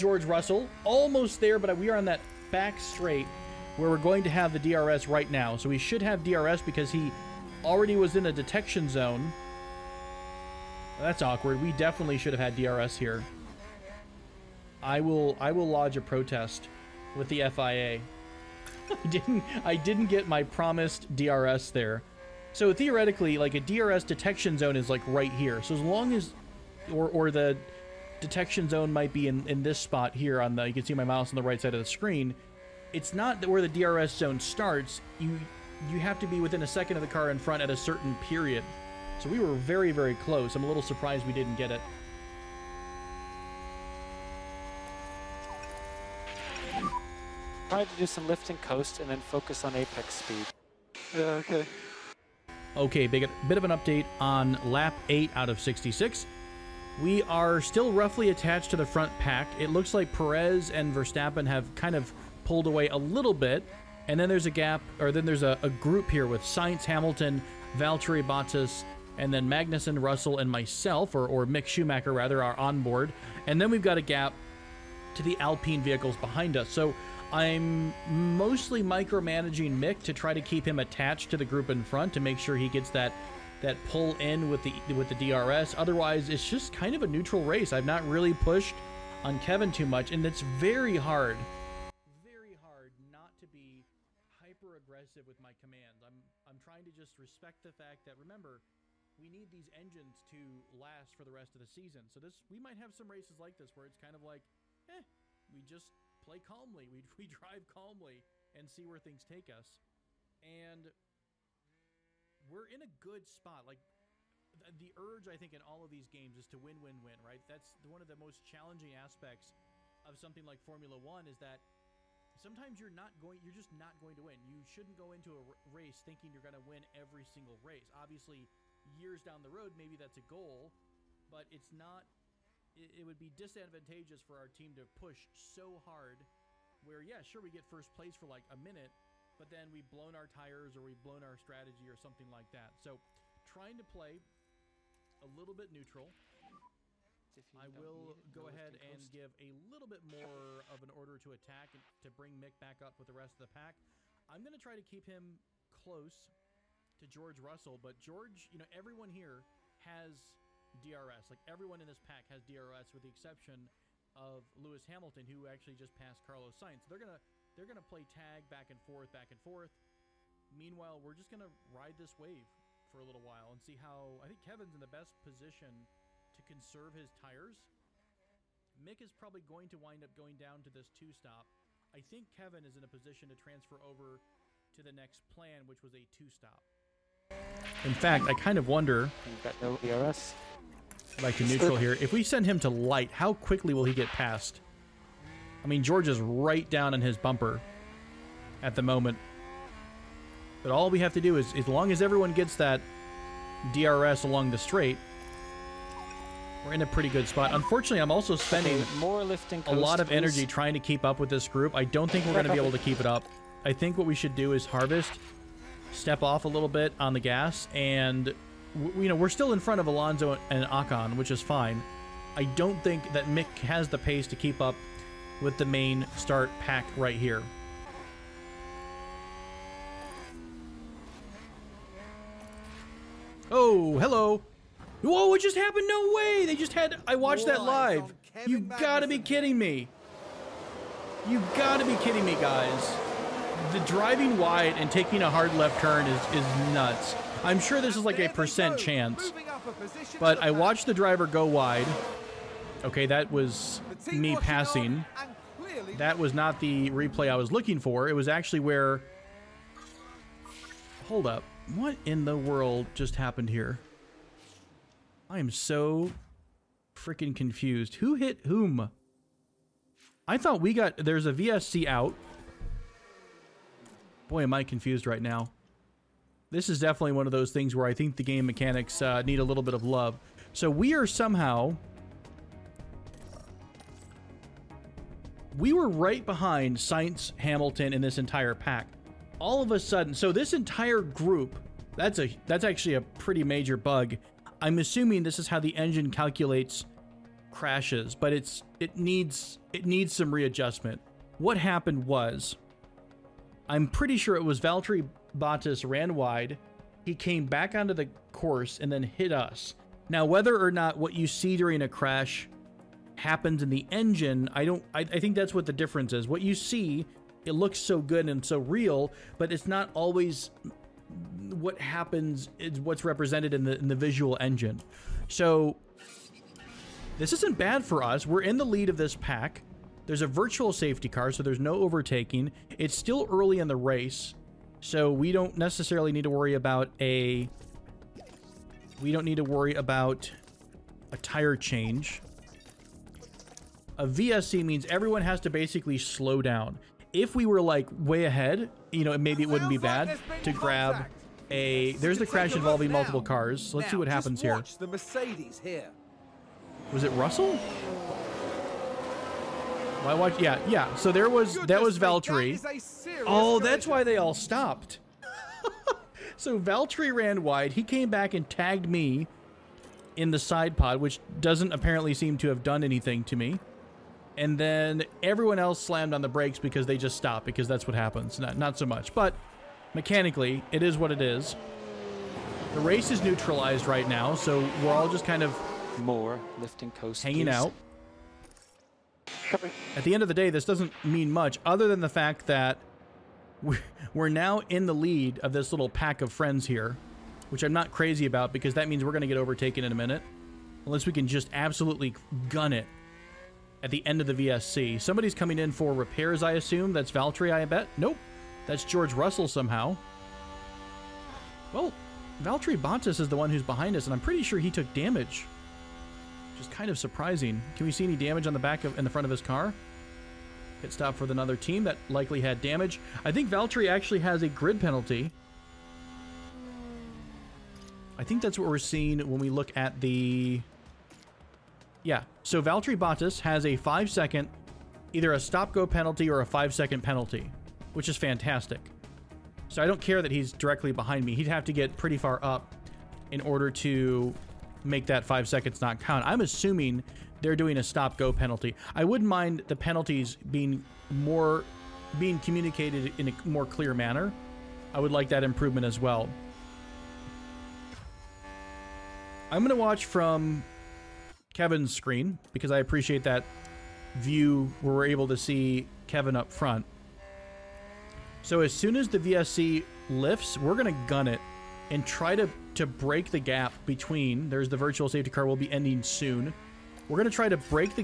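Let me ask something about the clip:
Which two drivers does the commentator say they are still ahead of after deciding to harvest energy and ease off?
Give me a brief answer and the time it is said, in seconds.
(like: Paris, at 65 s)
Alonso and Ocon, at 219 s.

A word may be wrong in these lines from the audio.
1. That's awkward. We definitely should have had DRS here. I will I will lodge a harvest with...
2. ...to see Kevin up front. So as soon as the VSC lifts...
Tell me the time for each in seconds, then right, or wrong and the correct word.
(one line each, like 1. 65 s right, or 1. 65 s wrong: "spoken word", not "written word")
1. 11 s wrong: "protest", not "harvest"
2. 465 s right.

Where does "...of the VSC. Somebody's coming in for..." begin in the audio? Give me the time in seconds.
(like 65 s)
404 s.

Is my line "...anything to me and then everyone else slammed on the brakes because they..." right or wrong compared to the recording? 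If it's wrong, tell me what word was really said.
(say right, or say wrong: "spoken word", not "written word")
right.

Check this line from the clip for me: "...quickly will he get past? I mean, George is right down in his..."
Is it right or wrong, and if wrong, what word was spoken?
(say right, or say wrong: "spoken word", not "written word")
right.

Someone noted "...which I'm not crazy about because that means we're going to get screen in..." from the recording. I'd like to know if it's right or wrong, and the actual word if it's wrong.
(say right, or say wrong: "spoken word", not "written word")
wrong: "overtaken", not "screen".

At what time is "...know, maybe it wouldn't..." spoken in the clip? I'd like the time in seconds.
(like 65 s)
349 s.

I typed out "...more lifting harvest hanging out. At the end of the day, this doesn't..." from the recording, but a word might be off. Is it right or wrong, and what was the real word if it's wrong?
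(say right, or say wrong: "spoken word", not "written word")
wrong: "coast", not "harvest".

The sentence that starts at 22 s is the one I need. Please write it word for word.
So theoretically, like a DRS detection zone is like right here.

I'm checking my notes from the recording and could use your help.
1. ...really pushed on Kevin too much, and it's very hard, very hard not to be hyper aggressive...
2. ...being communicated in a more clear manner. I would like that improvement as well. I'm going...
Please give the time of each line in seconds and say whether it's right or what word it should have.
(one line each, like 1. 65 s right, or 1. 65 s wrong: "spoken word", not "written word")
1. 88 s right
2. 452 s right.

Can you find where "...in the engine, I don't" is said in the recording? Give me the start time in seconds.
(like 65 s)
313 s.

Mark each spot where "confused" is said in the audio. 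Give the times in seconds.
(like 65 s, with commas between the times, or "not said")
267 s, 274 s.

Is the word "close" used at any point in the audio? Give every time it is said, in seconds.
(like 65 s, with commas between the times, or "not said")
40 s, 155 s.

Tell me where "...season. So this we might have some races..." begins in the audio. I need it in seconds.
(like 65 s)
101 s.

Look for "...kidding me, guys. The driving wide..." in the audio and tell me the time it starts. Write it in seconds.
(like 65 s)
241 s.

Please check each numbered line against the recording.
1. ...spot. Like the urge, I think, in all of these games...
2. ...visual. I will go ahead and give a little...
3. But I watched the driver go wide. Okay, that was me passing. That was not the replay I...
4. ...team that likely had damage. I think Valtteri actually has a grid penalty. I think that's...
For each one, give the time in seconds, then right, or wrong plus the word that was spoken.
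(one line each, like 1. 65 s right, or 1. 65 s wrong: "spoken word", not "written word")
1. 113 s right
2. 145 s wrong: "neutral", not "visual"
3. 250 s right
4. 421 s right.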